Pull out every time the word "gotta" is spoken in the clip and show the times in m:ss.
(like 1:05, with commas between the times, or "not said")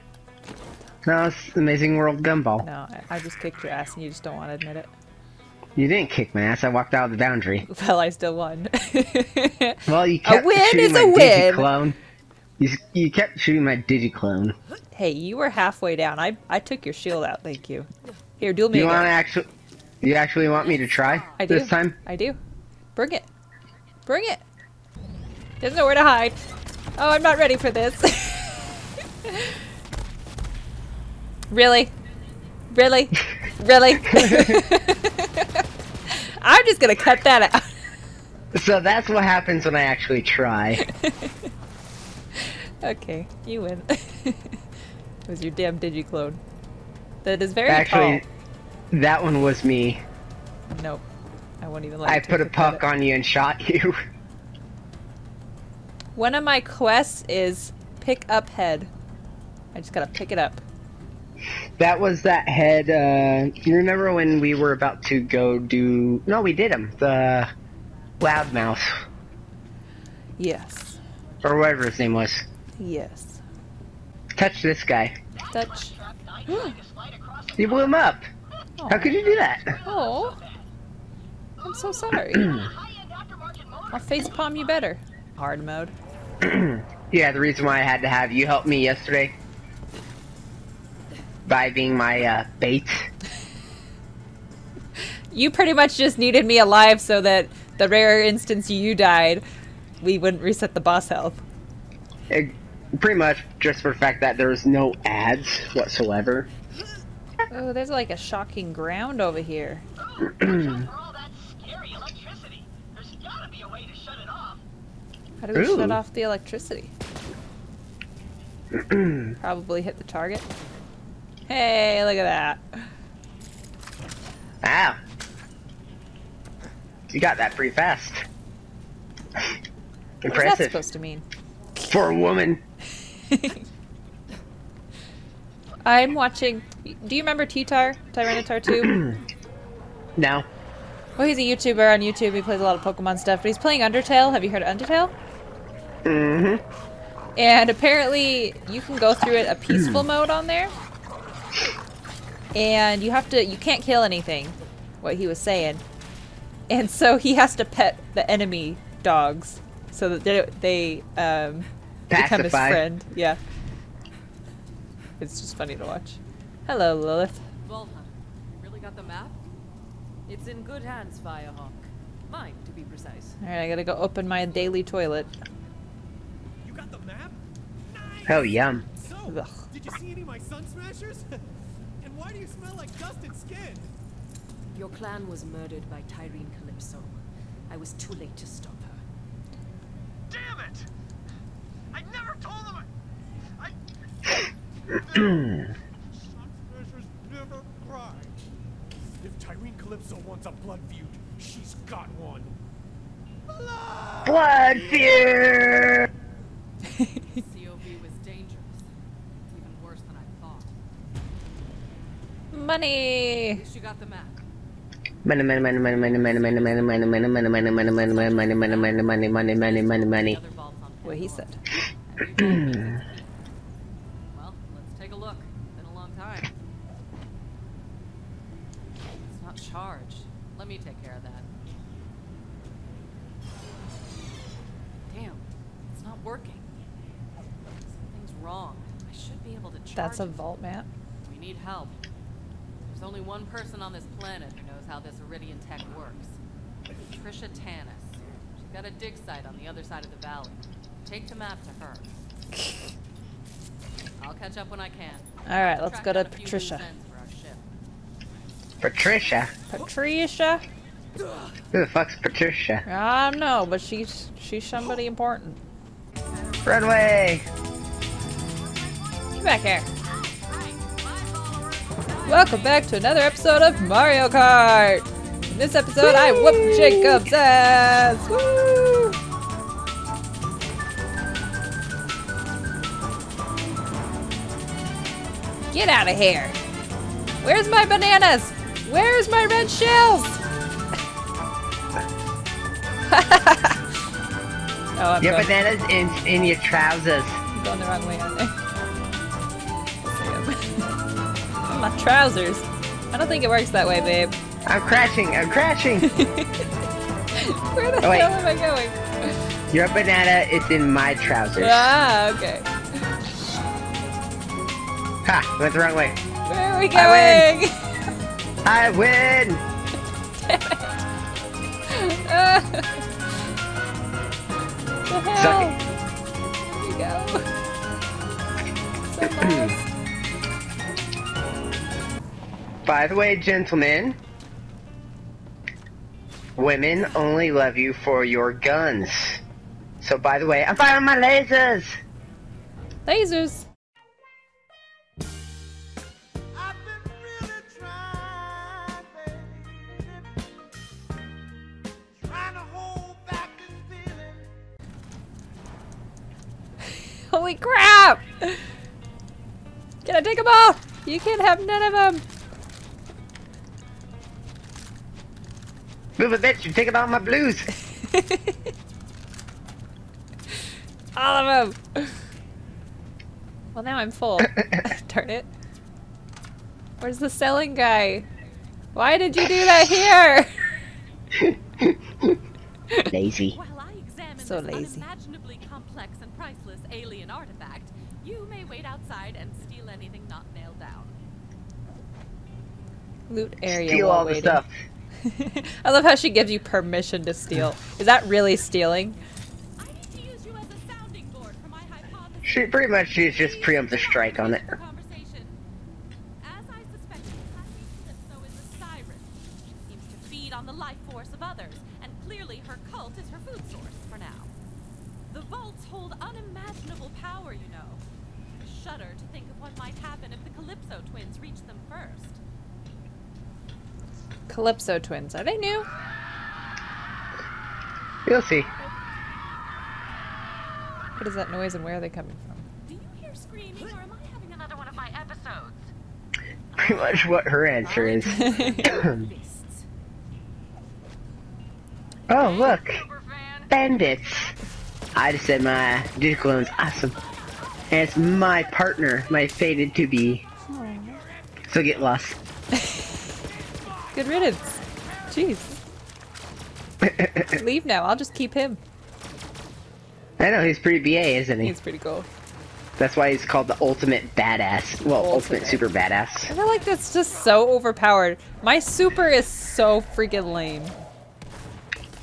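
0:59, 2:53.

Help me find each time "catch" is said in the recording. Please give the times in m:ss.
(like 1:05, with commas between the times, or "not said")
4:14.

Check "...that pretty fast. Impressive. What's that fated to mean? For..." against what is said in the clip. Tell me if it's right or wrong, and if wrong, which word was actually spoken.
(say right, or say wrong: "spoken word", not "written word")
wrong: "supposed", not "fated".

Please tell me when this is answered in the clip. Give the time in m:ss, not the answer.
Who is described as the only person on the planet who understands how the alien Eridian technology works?
4:07.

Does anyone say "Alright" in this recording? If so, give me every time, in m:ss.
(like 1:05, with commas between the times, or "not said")
2:53, 4:15.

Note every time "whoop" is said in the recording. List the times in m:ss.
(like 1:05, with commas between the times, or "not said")
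4:36.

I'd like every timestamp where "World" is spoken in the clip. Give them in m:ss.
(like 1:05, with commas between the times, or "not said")
0:01.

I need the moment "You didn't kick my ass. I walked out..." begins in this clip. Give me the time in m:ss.
0:05.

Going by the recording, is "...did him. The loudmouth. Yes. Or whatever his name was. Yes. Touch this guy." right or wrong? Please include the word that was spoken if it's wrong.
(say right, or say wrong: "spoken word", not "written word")
right.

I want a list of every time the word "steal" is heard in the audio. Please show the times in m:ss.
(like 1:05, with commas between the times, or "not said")
6:29, 6:33.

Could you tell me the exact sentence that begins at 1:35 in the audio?
you pretty much just needed me alive so that the rare instance you died, we wouldn't reset the boss health.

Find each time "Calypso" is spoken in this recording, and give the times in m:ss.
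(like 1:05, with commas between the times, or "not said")
3:06, 3:19, 7:04.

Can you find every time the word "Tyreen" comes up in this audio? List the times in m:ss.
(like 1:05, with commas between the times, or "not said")
3:06, 3:19.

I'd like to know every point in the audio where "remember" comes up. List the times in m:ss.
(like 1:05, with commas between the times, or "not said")
1:03, 2:17.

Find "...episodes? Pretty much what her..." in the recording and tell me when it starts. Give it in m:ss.
7:15.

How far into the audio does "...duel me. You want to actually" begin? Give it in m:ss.
0:18.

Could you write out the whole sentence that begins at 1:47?
Oh, there's like a shocking ground over here.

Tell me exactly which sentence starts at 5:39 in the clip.
So by the way, I'm firing my lasers!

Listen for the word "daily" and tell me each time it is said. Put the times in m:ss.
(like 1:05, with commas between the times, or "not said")
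2:54.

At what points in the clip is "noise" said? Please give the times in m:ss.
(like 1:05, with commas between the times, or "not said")
7:11.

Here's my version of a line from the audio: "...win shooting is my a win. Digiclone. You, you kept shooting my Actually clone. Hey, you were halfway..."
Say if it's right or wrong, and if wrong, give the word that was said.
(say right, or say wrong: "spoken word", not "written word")
wrong: "Digi", not "Actually".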